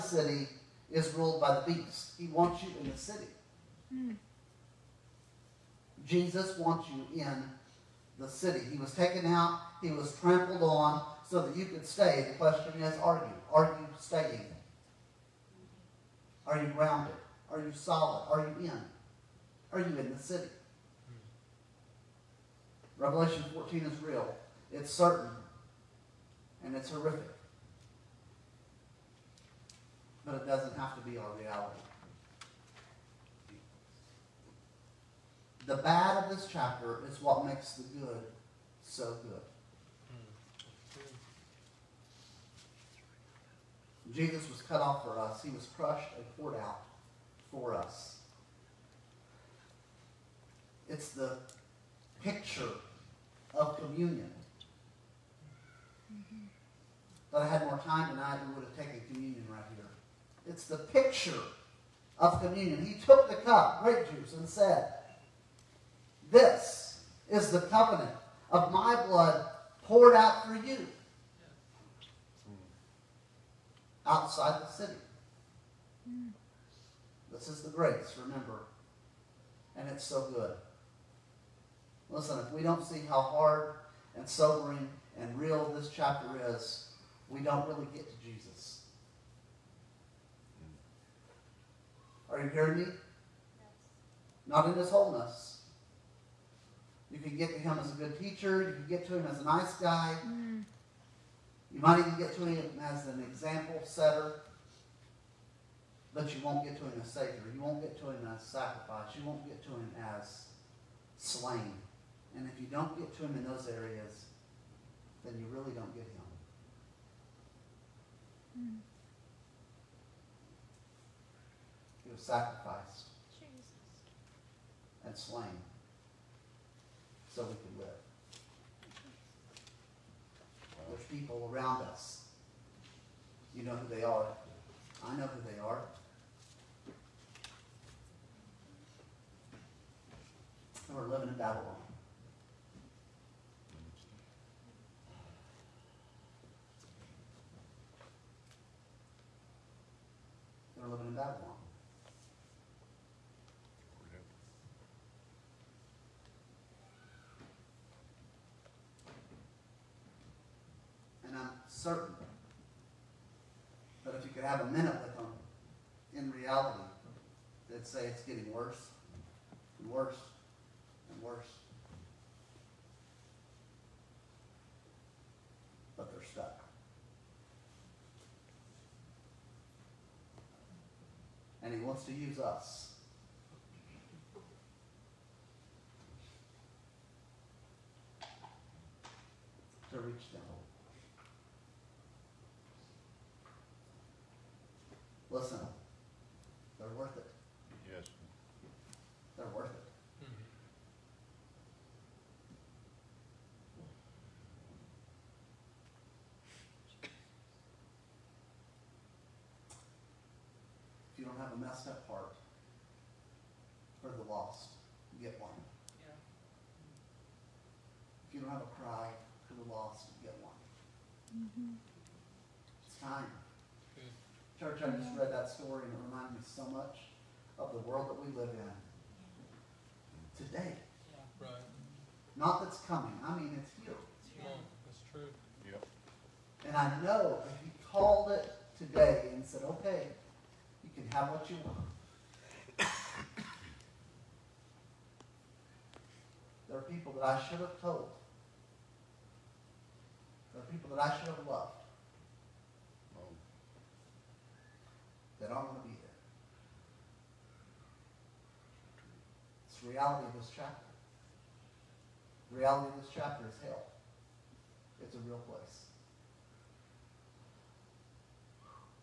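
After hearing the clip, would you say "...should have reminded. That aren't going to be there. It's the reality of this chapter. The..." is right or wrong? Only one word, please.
wrong.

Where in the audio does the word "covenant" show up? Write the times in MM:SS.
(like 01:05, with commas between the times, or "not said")
01:07.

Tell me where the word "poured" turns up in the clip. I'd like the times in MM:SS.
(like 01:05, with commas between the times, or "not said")
00:46, 01:09.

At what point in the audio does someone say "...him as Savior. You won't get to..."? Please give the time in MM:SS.
01:46.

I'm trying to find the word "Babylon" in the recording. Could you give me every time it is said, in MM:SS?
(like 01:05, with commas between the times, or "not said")
02:21, 02:31.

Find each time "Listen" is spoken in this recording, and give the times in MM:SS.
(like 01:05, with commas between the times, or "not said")
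01:22, 03:15.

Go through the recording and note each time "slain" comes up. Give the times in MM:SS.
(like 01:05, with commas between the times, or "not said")
01:51, 02:05.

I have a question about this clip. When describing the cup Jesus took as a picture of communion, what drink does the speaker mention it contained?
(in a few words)
grape juice.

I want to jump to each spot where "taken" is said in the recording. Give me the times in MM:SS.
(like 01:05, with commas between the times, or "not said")
00:08, 00:58.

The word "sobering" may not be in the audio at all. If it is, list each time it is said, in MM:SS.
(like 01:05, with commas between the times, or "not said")
01:24.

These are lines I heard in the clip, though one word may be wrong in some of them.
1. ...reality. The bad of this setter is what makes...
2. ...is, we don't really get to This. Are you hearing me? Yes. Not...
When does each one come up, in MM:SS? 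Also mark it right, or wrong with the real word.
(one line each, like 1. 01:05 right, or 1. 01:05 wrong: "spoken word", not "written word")
1. 00:31 wrong: "chapter", not "setter"
2. 01:26 wrong: "Jesus", not "This".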